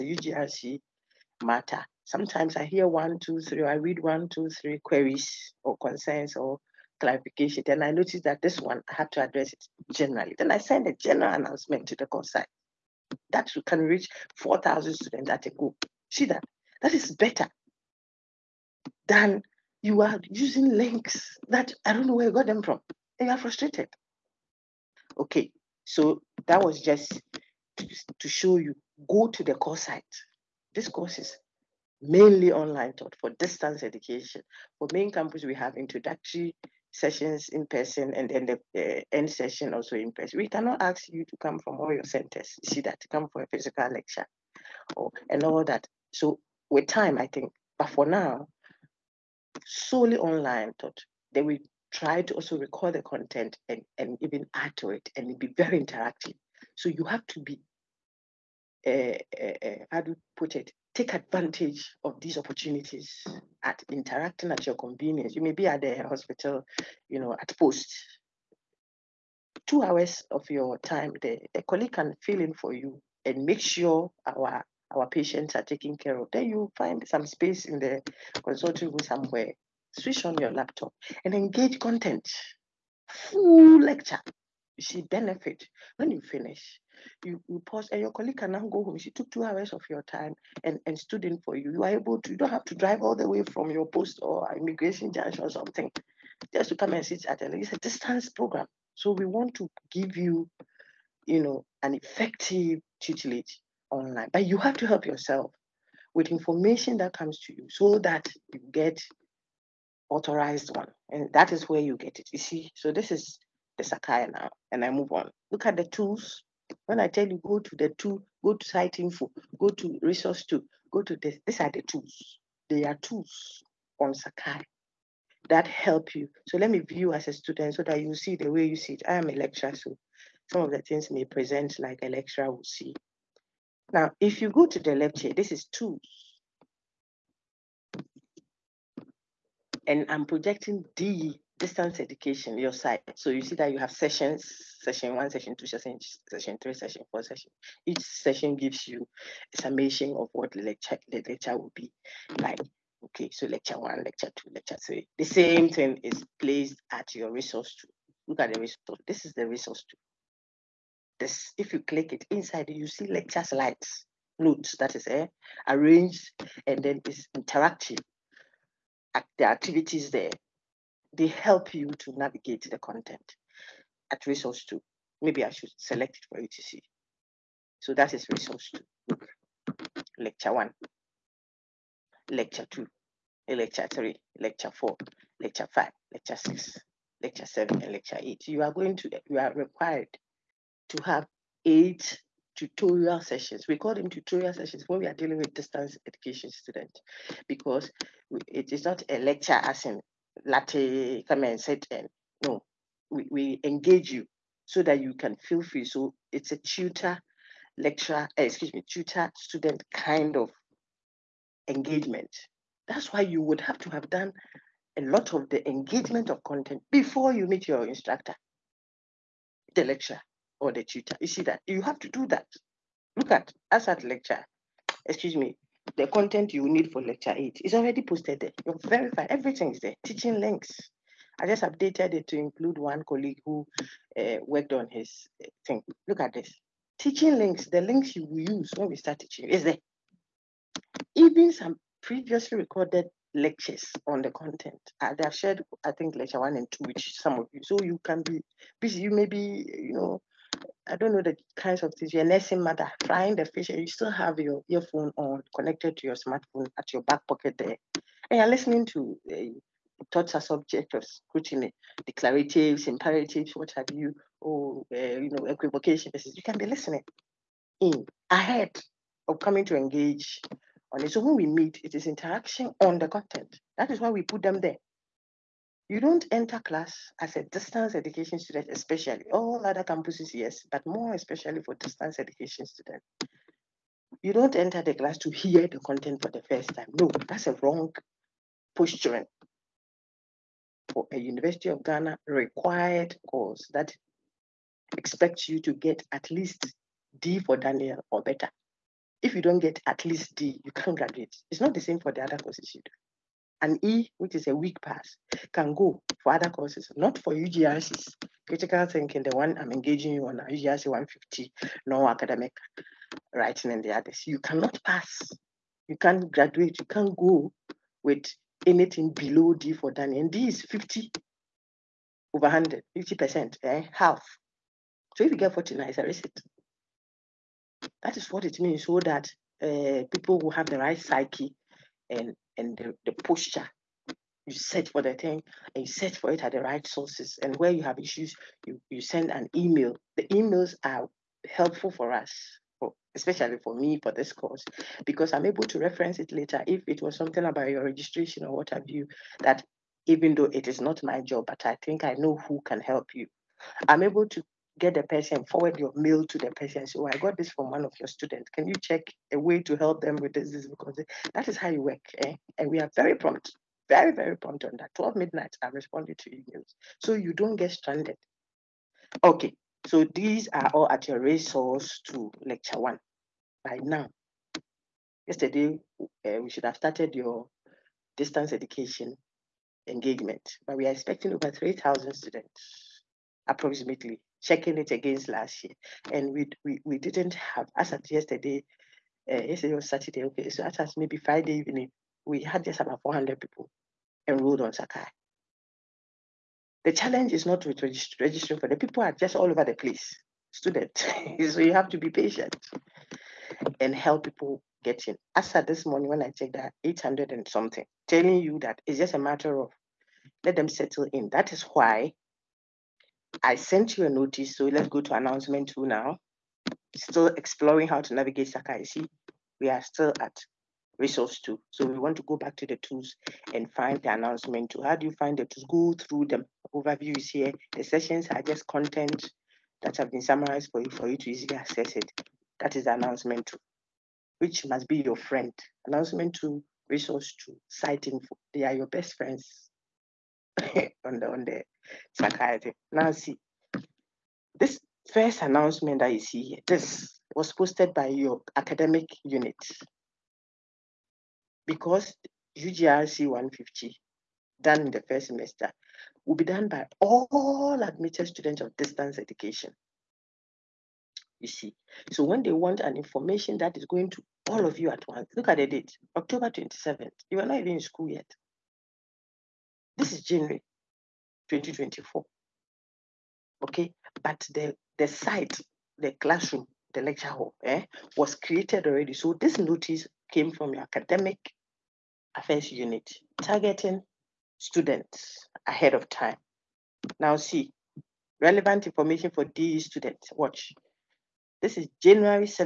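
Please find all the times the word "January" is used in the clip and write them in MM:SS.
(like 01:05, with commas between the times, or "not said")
07:50, 08:12.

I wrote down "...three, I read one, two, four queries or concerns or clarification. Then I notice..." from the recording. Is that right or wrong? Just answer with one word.
wrong.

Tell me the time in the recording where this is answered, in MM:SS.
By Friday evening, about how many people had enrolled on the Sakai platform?
06:33.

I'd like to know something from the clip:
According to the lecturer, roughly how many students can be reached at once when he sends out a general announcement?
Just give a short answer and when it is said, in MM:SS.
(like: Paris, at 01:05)
4,000, at 00:14.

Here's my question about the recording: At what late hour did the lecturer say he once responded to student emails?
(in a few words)
12 midnight.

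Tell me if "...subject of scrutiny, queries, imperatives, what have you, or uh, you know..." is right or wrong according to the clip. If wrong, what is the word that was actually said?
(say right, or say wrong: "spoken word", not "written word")
wrong: "declaratives", not "queries".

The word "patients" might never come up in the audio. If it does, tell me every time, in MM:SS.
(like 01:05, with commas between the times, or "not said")
01:15, 06:42.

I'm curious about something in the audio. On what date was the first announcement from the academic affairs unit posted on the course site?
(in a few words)
October 27.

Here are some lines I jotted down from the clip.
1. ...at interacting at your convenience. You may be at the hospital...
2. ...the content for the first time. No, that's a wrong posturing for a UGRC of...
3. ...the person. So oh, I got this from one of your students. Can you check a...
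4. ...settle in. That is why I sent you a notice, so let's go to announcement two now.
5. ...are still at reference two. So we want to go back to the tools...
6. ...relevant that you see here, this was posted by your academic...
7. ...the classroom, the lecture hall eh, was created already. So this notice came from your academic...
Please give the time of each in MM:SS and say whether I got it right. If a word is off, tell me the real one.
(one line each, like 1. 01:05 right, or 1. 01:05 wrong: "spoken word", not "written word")
1. 01:03 right
2. 04:45 wrong: "University", not "UGRC"
3. 05:56 right
4. 06:50 right
5. 06:59 wrong: "resource", not "reference"
6. 07:25 wrong: "announcement", not "relevant"
7. 07:55 right.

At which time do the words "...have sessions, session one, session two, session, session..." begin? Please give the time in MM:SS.
02:23.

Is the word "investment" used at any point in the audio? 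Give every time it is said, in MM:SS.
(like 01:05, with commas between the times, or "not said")
not said.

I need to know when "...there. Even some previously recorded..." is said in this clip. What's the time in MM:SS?
03:59.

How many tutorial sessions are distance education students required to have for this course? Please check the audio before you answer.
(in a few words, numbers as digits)
8.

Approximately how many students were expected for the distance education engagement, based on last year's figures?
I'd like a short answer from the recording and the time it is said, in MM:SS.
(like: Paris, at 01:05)
3,000, at 06:21.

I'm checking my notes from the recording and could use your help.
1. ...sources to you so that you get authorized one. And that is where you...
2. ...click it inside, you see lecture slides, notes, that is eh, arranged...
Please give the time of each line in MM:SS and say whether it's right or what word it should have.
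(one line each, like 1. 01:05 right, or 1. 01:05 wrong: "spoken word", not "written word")
1. 01:47 wrong: "comes", not "sources"
2. 02:41 right.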